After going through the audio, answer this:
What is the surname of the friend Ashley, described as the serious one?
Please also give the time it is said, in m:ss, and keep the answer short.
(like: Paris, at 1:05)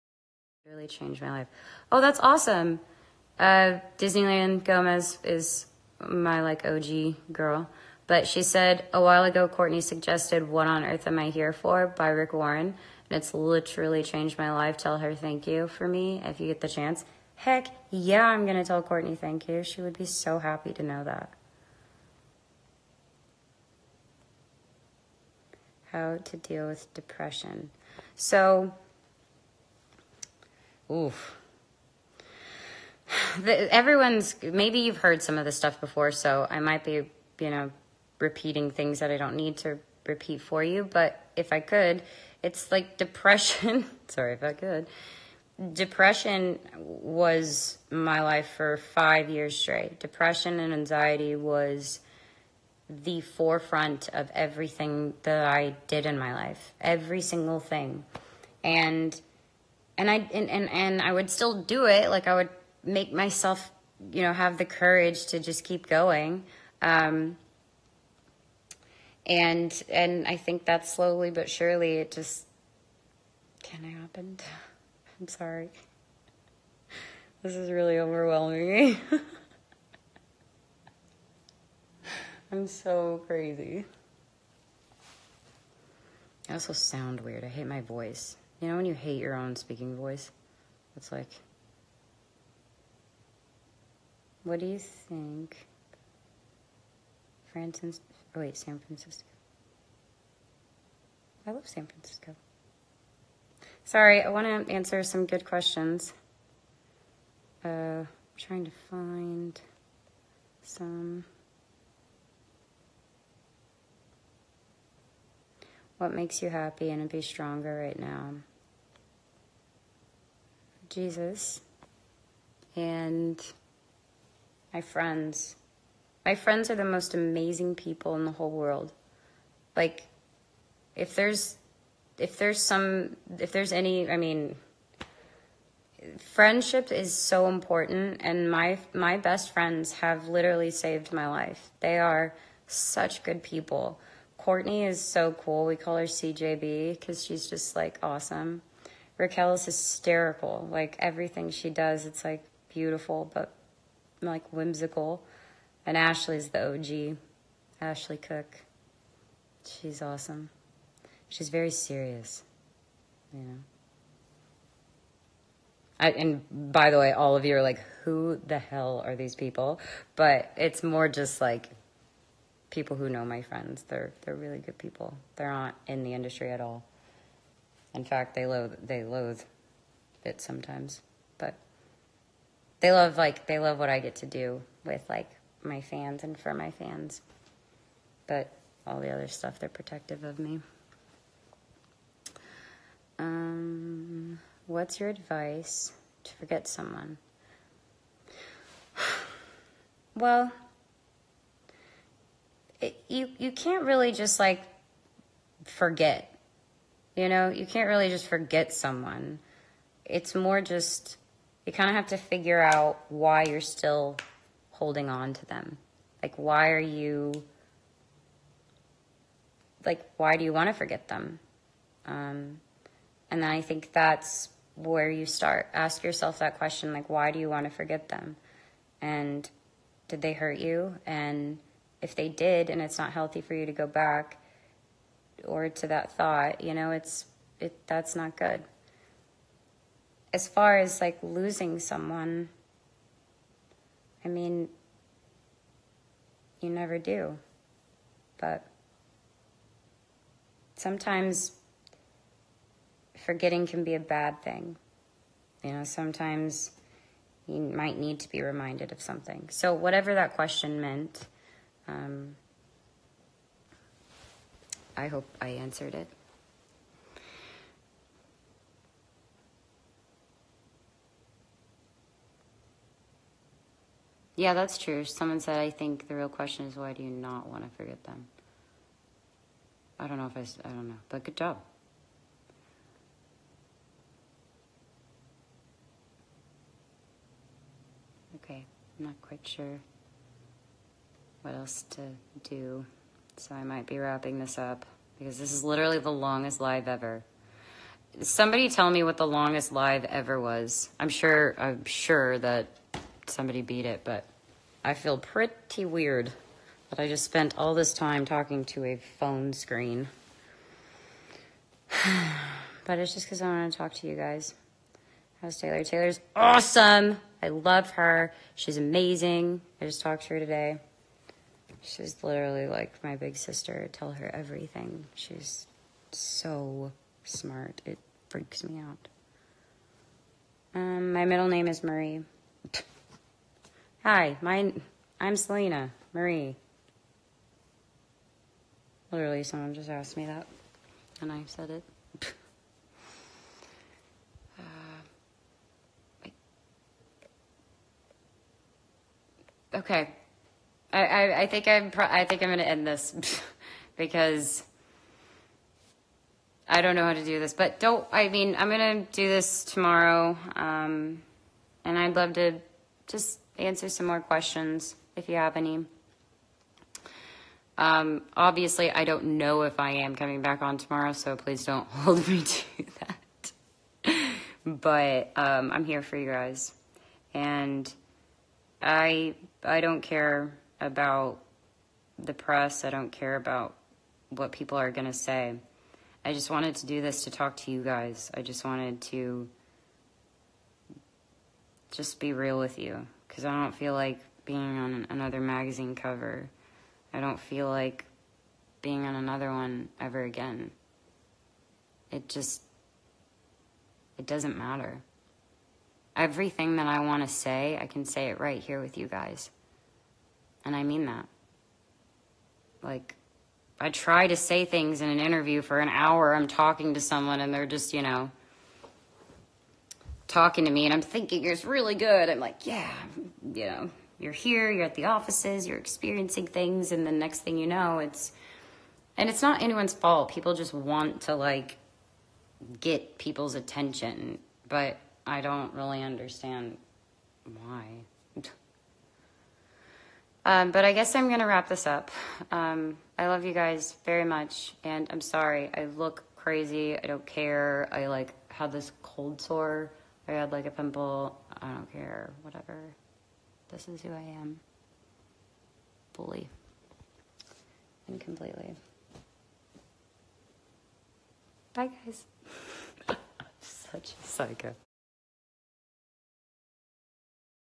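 Cook, at 2:37.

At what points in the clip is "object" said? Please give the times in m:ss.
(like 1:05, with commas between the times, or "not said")
not said.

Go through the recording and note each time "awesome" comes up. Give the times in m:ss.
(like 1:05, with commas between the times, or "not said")
0:02, 2:28, 2:40, 5:16.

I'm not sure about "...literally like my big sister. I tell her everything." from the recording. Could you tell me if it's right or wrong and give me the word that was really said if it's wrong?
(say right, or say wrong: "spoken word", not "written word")
right.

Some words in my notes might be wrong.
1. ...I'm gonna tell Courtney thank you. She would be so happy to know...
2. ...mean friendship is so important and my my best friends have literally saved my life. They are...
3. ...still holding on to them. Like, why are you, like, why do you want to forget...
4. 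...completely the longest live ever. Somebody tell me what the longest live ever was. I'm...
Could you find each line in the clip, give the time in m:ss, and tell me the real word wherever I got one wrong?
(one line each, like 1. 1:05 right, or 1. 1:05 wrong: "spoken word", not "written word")
1. 0:18 right
2. 2:14 right
3. 3:33 right
4. 4:55 wrong: "literally", not "completely".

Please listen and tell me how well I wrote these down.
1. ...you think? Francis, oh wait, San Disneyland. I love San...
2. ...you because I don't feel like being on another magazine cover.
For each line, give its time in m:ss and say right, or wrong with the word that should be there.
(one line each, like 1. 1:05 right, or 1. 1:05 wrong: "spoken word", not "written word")
1. 1:34 wrong: "Francisco", not "Disneyland"
2. 6:32 right.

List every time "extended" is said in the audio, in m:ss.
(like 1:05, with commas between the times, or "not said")
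not said.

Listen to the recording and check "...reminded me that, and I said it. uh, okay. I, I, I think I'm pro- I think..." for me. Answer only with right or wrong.
wrong.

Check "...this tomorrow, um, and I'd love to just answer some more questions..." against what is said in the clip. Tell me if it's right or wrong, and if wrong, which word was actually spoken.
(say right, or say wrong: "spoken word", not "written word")
right.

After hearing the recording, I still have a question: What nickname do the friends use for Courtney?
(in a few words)
CJB.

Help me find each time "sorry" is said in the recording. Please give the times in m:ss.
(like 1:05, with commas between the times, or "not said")
0:44, 1:15, 1:43, 7:25.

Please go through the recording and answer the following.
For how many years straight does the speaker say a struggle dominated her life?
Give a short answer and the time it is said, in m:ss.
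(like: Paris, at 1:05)
5, at 0:48.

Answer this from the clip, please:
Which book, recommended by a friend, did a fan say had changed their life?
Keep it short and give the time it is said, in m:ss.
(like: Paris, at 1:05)
What on Earth Am I Here For, at 0:10.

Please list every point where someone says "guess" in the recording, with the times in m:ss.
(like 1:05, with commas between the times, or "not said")
7:20.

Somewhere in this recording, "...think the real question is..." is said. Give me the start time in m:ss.
4:35.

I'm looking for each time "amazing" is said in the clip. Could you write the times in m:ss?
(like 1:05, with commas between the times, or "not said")
2:07, 5:18.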